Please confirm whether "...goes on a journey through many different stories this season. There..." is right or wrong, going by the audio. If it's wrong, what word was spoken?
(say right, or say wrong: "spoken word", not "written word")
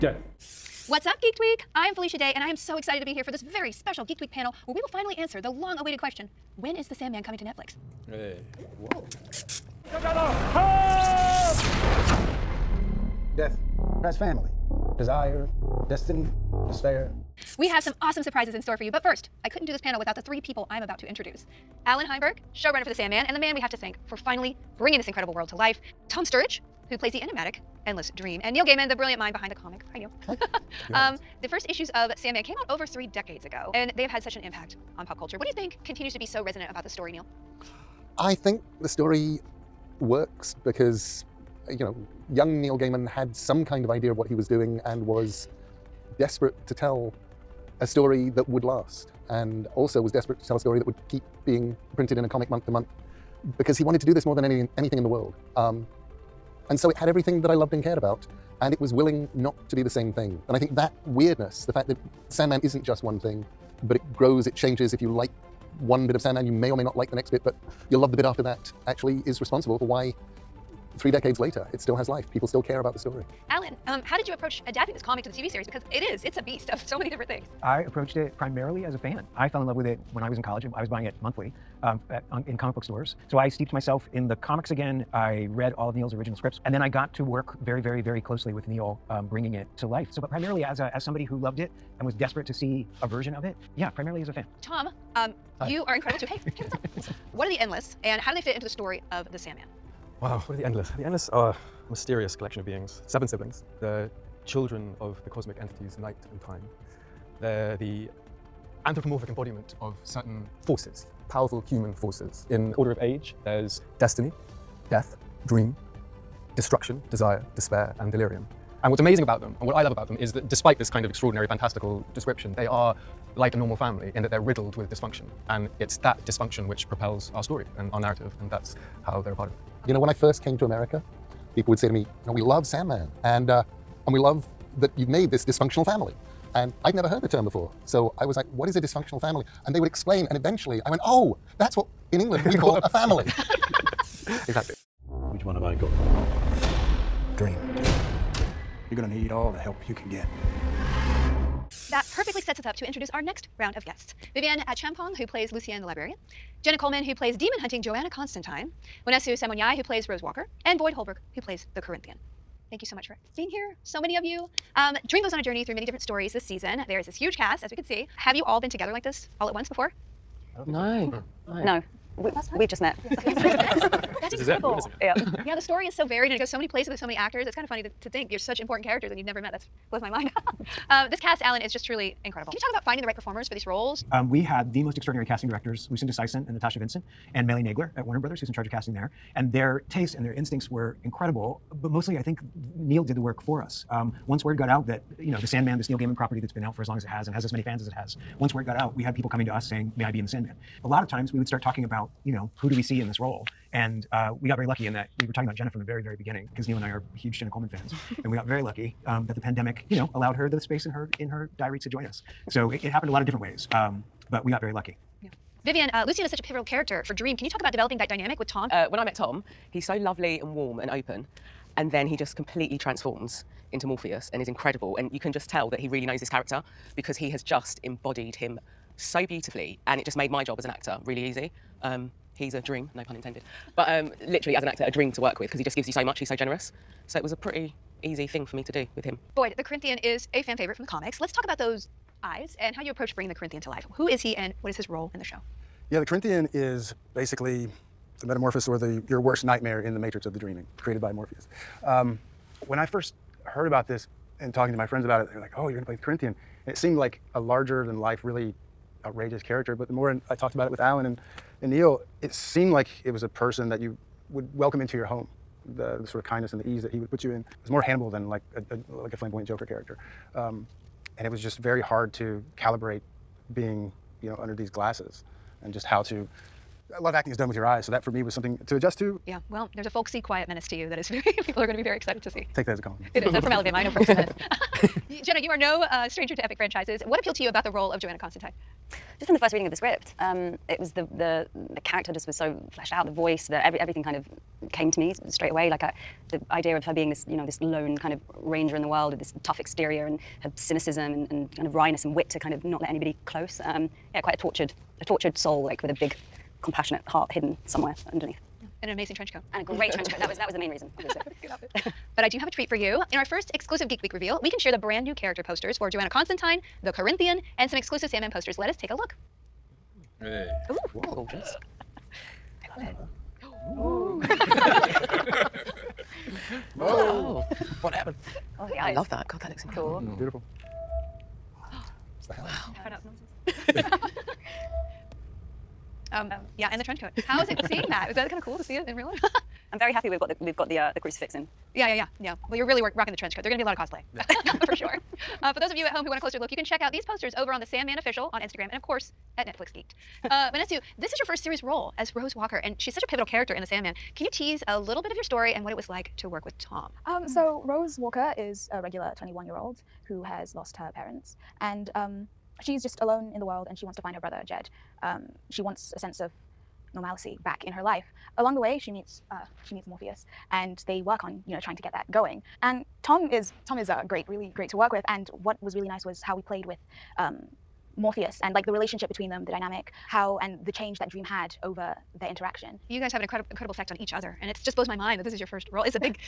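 right.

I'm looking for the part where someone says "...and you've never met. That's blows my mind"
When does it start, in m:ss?
2:59.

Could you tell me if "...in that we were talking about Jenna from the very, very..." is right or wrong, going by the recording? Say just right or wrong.
right.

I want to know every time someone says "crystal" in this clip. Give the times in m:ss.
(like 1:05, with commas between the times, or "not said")
not said.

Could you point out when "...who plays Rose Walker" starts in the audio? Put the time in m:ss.
2:39.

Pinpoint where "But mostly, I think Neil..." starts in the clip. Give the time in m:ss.
3:11.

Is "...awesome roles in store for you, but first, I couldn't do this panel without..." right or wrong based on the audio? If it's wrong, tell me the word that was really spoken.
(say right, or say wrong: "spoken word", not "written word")
wrong: "surprises", not "roles".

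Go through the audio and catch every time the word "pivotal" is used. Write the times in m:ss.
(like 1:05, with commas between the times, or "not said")
3:36, 5:53.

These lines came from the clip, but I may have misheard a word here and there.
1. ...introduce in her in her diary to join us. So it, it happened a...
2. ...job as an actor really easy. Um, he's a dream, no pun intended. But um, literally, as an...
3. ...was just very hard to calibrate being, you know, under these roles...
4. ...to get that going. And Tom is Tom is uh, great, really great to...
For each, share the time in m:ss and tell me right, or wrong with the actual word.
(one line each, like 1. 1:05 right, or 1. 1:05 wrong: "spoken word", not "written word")
1. 3:30 wrong: "space", not "introduce"
2. 3:50 right
3. 4:31 wrong: "glasses", not "roles"
4. 6:11 right.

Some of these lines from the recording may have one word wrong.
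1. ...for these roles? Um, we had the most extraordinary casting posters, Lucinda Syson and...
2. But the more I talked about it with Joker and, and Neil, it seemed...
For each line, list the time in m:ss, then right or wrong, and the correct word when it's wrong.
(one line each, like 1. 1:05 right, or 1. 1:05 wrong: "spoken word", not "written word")
1. 3:03 wrong: "directors", not "posters"
2. 4:19 wrong: "Alan", not "Joker".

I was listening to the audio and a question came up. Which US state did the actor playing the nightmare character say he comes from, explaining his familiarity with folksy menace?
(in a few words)
Alabama.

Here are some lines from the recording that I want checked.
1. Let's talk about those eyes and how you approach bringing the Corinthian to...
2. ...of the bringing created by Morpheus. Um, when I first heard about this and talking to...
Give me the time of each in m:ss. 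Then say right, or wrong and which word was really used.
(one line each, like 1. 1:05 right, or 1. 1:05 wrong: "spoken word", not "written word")
1. 4:01 right
2. 4:10 wrong: "dreaming", not "bringing".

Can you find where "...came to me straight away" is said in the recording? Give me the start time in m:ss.
4:54.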